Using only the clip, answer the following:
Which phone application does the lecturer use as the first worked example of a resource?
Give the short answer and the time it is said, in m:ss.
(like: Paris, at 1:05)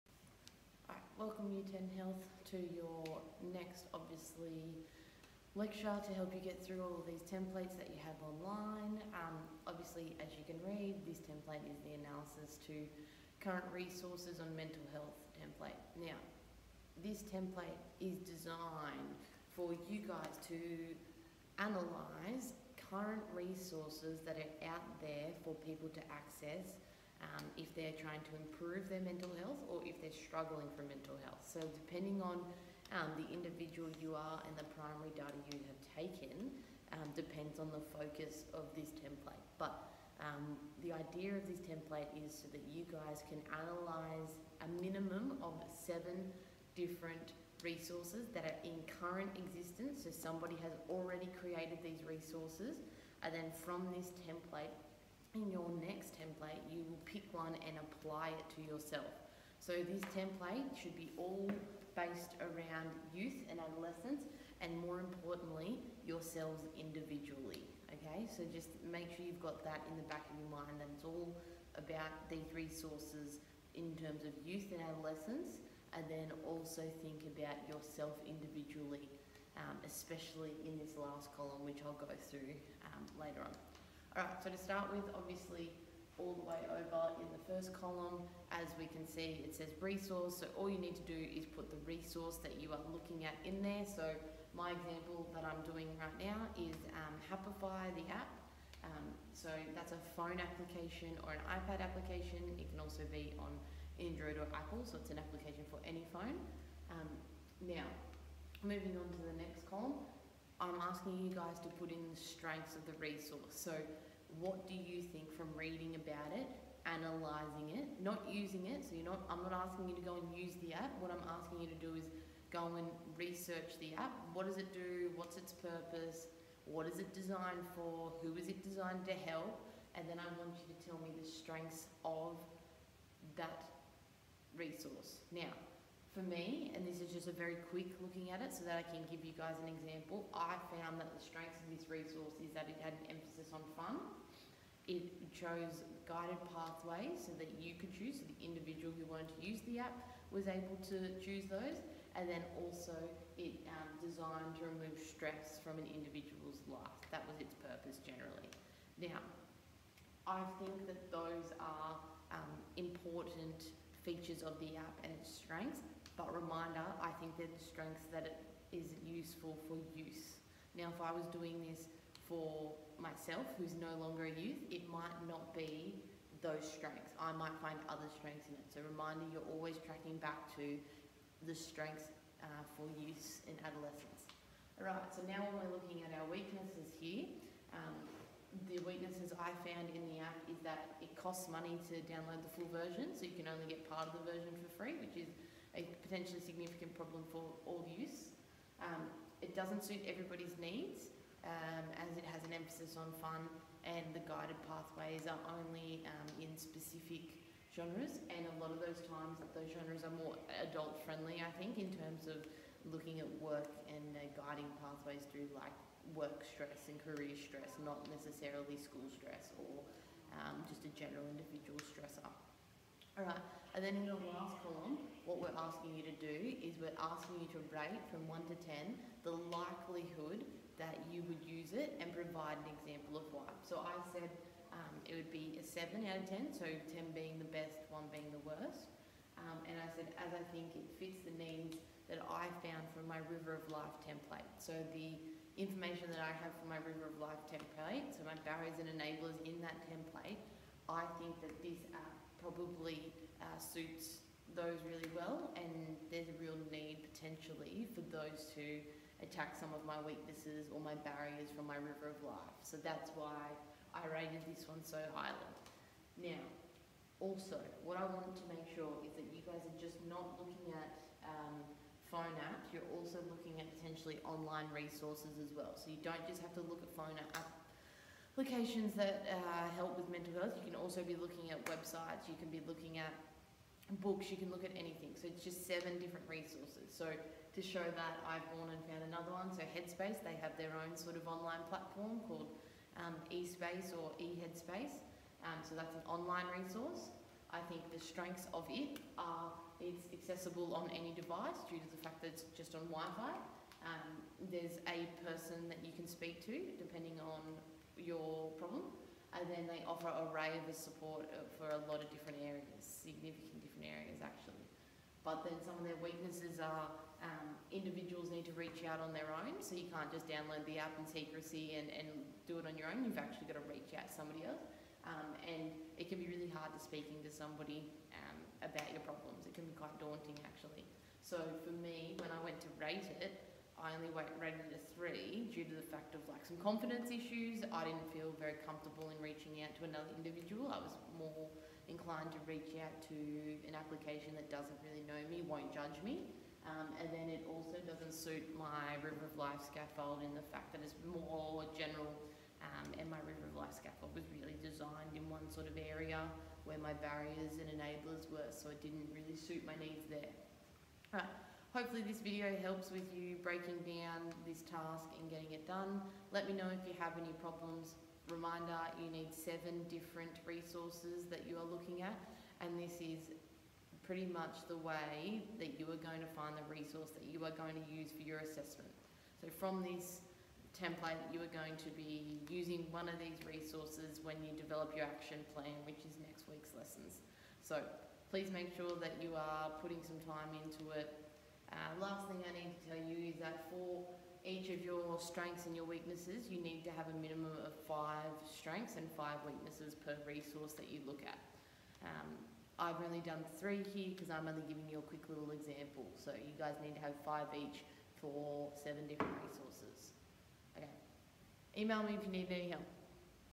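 Happify, at 1:37.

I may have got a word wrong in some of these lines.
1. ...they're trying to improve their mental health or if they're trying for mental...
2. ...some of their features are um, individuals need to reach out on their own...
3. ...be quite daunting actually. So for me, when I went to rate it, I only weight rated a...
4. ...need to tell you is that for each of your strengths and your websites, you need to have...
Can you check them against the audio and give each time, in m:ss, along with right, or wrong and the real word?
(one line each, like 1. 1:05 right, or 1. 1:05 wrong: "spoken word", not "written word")
1. 0:27 wrong: "struggling", not "trying"
2. 5:15 wrong: "weaknesses", not "features"
3. 5:29 right
4. 6:32 wrong: "weaknesses", not "websites".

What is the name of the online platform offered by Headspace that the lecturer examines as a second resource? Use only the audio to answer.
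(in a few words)
eHeadspace.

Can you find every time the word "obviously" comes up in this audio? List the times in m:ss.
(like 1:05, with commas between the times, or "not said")
0:03, 0:09, 1:25.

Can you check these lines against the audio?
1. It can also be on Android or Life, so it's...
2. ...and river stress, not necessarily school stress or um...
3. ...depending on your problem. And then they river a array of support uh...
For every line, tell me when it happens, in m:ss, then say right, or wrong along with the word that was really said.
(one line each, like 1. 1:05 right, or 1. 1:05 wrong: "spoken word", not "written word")
1. 1:42 wrong: "Apple", not "Life"
2. 3:36 wrong: "career", not "river"
3. 5:06 wrong: "offer", not "river".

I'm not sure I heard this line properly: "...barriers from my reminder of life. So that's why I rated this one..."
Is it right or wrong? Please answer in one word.
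wrong.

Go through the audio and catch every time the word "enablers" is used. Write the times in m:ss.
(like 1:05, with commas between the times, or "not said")
4:08, 5:57.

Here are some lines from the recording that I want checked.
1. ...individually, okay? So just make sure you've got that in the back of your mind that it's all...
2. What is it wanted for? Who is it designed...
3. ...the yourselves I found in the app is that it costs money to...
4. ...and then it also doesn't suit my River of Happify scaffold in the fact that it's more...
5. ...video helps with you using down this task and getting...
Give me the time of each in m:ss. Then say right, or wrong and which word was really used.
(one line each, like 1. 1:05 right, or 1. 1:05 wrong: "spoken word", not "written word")
1. 1:06 right
2. 2:06 wrong: "designed", not "wanted"
3. 3:08 wrong: "weaknesses", not "yourselves"
4. 5:47 wrong: "Life", not "Happify"
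5. 6:02 wrong: "breaking", not "using".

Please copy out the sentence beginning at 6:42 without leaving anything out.
Um, I've only done three here because I'm only giving you a quick little example.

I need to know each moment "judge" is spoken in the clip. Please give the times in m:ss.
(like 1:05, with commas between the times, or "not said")
5:45.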